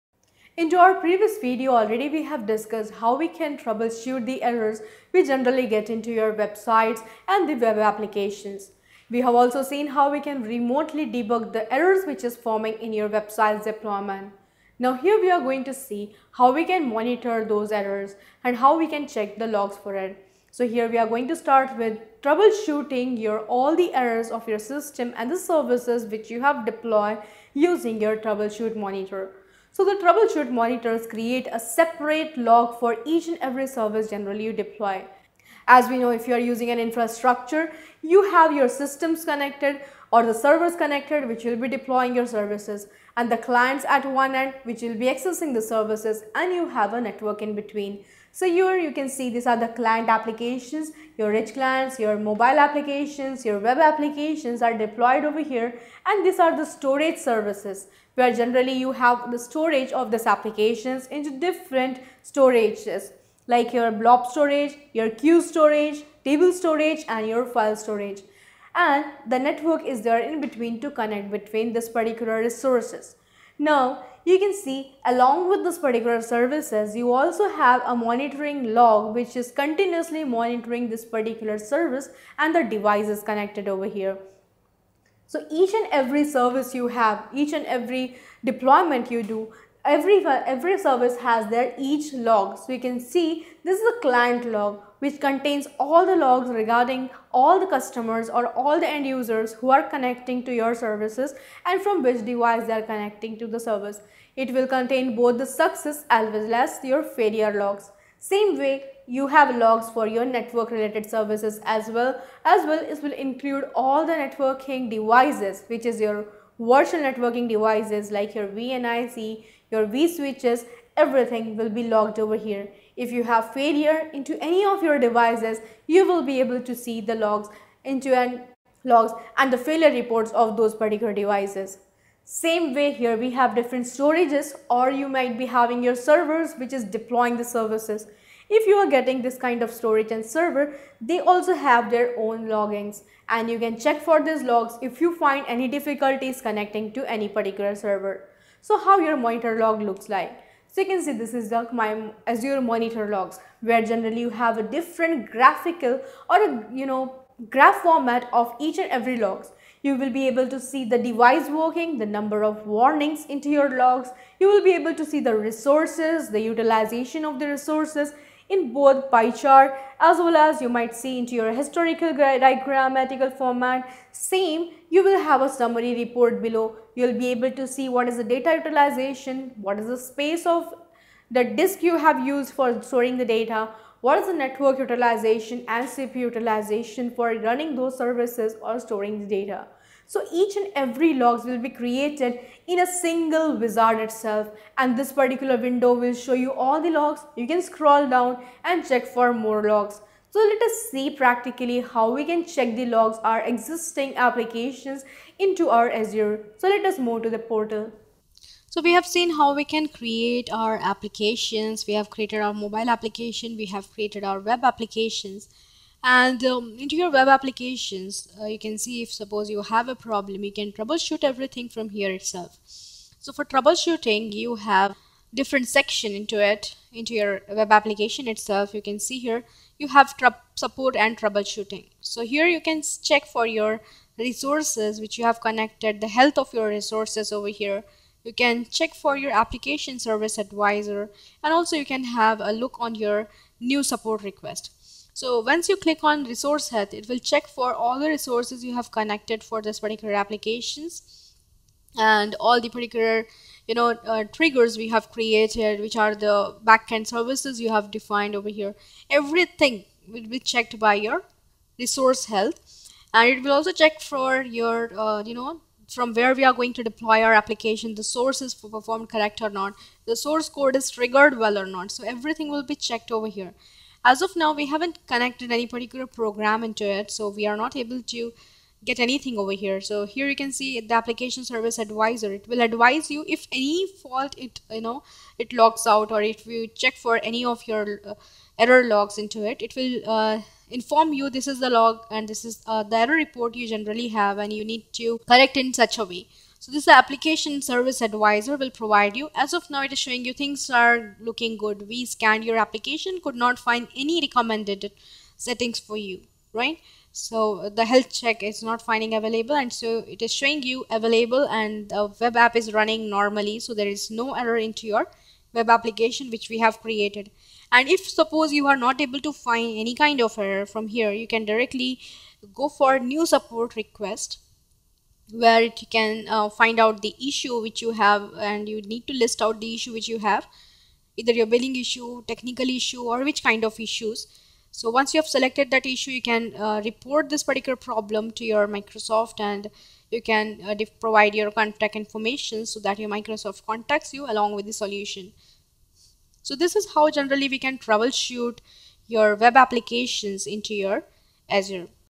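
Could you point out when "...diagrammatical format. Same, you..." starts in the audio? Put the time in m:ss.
2:52.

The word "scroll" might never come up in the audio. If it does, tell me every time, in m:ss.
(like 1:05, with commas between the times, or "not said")
3:17.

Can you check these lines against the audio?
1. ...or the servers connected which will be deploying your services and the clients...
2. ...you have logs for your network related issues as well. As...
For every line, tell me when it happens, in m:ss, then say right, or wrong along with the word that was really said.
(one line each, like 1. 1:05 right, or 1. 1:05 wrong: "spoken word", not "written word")
1. 0:40 right
2. 1:49 wrong: "services", not "issues".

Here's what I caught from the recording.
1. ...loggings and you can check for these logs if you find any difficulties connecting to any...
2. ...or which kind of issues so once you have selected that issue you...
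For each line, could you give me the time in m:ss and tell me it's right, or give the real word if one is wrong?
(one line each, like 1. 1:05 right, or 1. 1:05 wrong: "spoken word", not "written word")
1. 2:22 right
2. 5:33 right.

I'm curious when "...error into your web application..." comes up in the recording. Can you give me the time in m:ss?
5:14.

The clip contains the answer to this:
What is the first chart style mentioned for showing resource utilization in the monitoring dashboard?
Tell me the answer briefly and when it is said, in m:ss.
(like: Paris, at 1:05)
pie chart, at 2:49.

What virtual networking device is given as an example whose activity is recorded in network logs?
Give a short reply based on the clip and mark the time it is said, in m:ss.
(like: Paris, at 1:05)
VNIC, at 1:58.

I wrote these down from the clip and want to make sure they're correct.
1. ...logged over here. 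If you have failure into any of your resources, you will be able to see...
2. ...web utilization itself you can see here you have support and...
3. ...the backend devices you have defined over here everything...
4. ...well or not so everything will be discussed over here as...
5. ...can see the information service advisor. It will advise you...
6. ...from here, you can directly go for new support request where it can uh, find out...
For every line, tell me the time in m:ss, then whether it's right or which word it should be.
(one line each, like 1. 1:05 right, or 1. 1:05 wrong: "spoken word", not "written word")
1. 2:01 wrong: "devices", not "resources"
2. 3:47 wrong: "application", not "utilization"
3. 4:16 wrong: "services", not "devices"
4. 4:31 wrong: "checked", not "discussed"
5. 4:40 wrong: "application", not "information"
6. 5:20 right.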